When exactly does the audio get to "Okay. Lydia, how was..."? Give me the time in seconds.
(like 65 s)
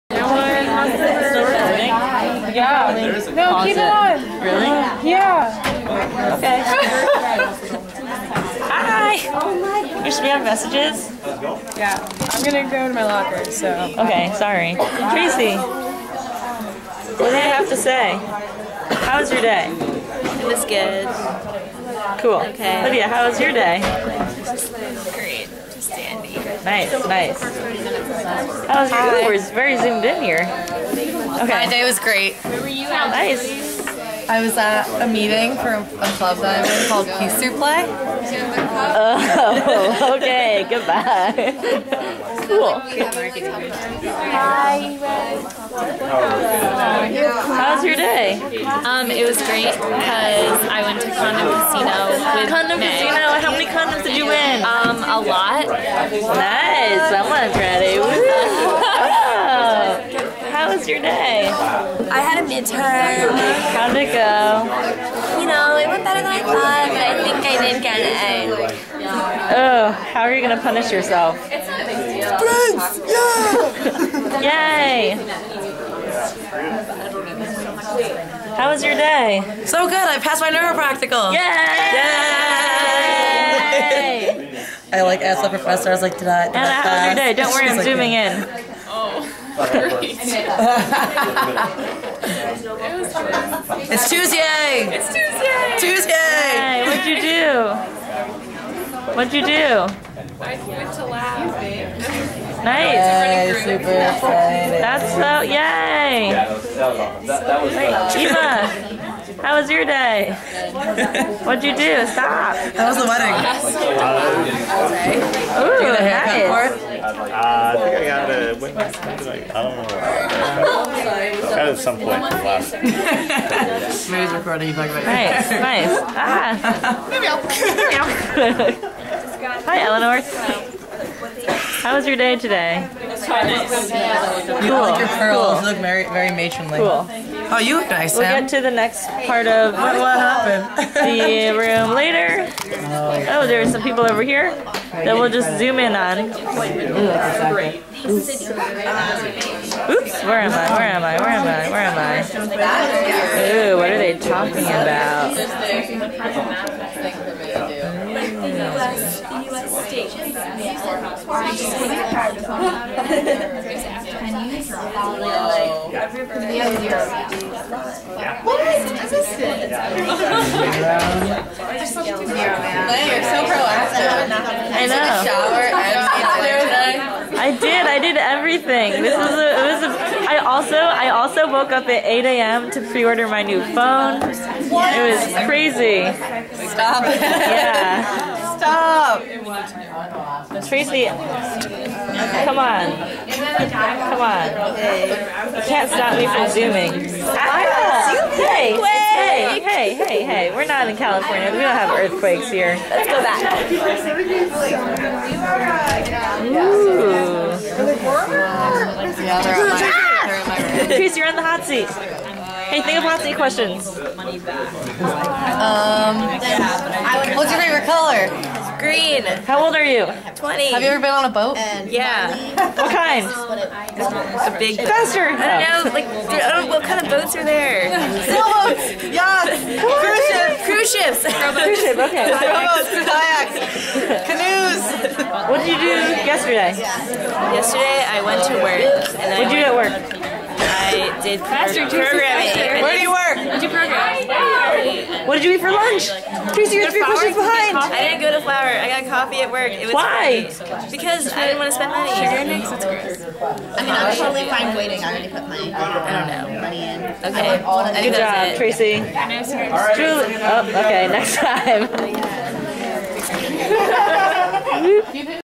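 22 s.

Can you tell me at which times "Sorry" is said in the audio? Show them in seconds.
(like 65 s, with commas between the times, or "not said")
14 s.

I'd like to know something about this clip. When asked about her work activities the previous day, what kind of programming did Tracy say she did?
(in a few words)
classroom programming.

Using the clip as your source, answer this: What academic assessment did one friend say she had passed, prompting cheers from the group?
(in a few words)
neuropractical.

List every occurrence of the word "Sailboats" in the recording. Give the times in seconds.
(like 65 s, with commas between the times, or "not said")
228 s.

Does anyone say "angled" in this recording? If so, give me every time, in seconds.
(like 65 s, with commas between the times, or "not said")
not said.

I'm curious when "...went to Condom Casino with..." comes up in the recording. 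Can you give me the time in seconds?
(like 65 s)
50 s.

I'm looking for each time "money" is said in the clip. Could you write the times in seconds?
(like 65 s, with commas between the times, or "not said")
251 s, 256 s.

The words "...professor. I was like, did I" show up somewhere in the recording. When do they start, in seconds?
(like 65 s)
85 s.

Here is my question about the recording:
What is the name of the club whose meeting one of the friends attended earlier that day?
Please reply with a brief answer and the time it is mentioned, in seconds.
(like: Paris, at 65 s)
Peace Through Play, at 37 s.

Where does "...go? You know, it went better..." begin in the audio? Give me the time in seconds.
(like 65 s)
64 s.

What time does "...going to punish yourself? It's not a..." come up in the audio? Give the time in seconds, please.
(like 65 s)
70 s.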